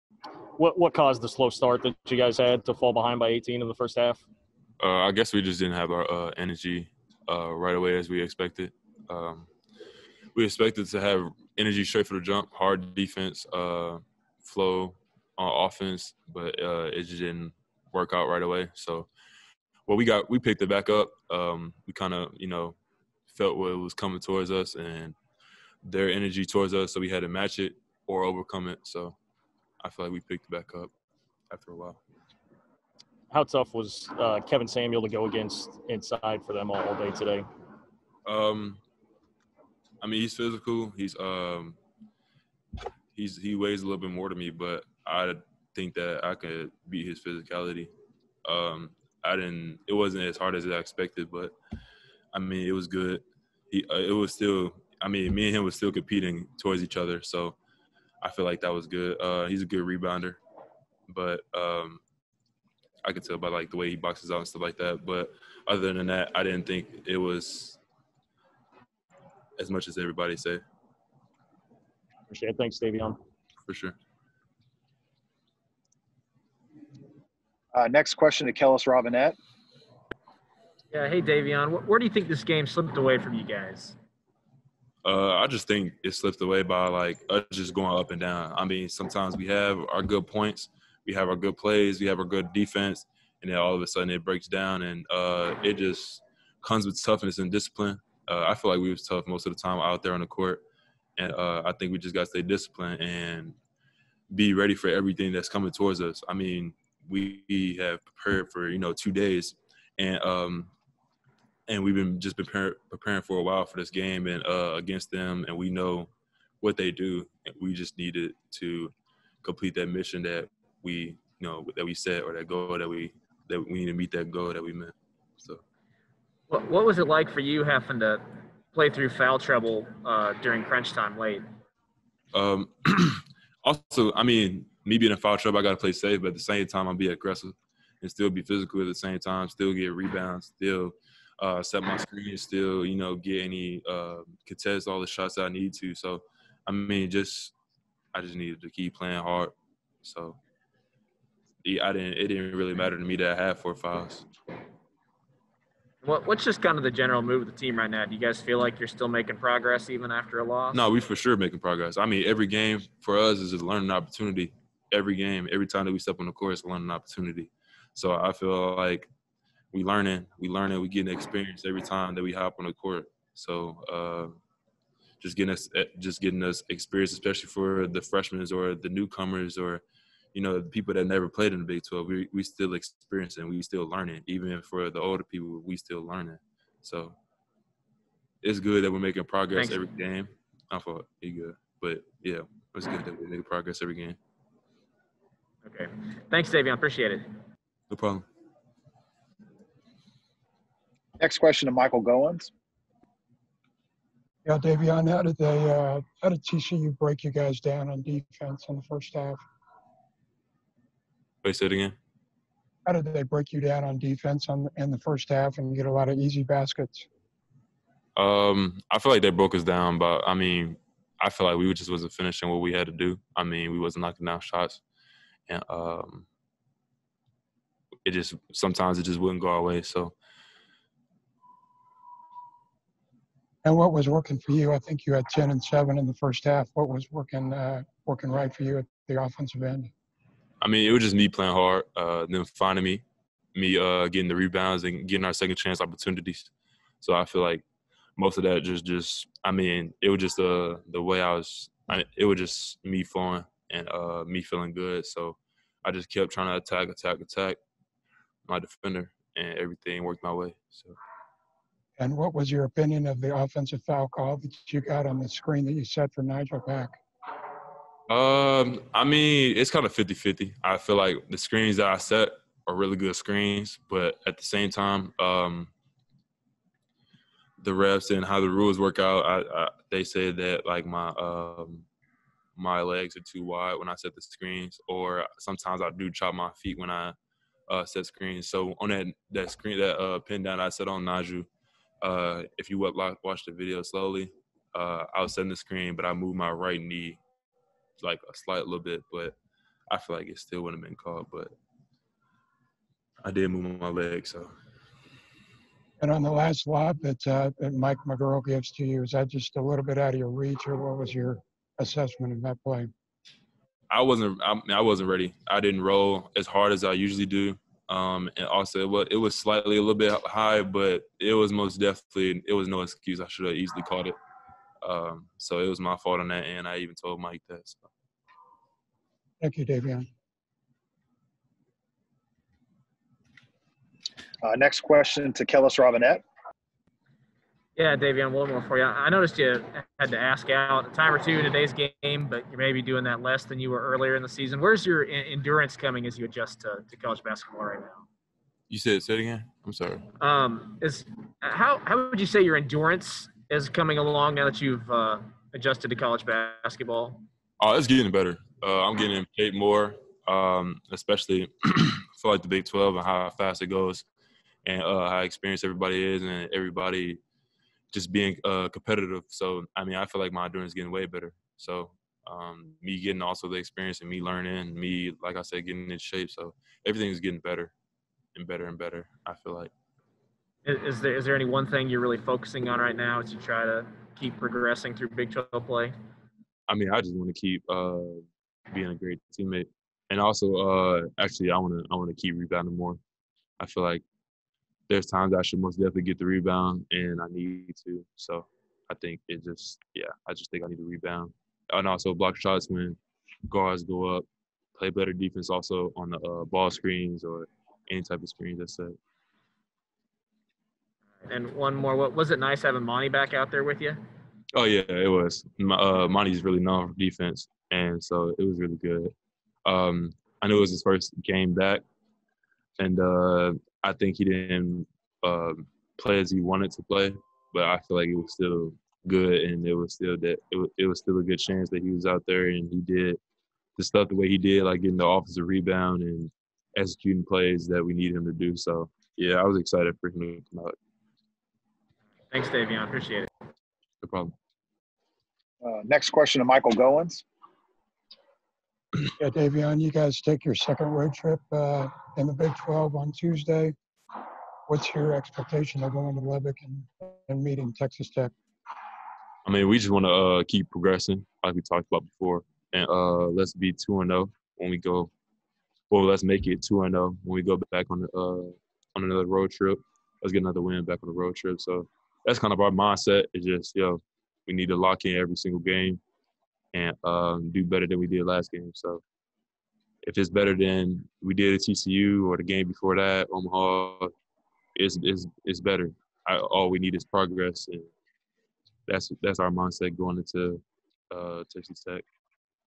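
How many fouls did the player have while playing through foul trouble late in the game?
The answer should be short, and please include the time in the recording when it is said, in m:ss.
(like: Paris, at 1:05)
4, at 2:33.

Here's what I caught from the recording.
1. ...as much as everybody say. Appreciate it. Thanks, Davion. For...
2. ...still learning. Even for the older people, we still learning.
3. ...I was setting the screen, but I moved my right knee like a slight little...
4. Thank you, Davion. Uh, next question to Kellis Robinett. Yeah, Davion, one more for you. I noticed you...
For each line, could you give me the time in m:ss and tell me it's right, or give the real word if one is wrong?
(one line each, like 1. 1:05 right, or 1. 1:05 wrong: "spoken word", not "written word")
1. 1:09 right
2. 3:03 right
3. 4:55 right
4. 5:29 right.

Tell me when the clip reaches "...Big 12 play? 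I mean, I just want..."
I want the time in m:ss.
6:25.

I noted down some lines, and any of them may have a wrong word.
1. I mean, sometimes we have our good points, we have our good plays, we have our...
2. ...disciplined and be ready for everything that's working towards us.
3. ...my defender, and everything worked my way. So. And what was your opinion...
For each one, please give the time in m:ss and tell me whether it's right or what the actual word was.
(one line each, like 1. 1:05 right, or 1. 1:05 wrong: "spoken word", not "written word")
1. 1:28 right
2. 1:42 wrong: "coming", not "working"
3. 4:18 right.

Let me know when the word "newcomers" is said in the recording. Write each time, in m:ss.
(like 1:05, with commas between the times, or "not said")
2:58.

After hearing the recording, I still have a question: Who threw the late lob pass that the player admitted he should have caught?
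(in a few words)
Mike McGuirl.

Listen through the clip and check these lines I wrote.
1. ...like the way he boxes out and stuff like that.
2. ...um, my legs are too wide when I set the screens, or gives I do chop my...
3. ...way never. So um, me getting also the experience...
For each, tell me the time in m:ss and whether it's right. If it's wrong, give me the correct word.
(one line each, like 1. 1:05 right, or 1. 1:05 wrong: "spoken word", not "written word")
1. 1:03 right
2. 4:41 wrong: "sometimes", not "gives"
3. 6:10 wrong: "better", not "never".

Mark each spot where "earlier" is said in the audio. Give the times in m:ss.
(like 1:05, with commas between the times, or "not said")
5:43.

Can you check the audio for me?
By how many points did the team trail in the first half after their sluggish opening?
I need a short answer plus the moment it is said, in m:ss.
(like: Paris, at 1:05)
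18, at 0:03.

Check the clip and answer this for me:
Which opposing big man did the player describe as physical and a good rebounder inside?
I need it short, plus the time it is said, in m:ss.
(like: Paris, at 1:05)
Kevin Samuel, at 0:34.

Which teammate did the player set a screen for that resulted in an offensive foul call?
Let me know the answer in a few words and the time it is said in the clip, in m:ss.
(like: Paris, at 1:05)
Nijel Pack, at 4:26.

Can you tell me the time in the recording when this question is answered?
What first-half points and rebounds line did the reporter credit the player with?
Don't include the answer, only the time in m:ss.
3:55.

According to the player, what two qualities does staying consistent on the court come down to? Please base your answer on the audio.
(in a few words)
Toughness and discipline.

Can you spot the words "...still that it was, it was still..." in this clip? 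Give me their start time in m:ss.
7:09.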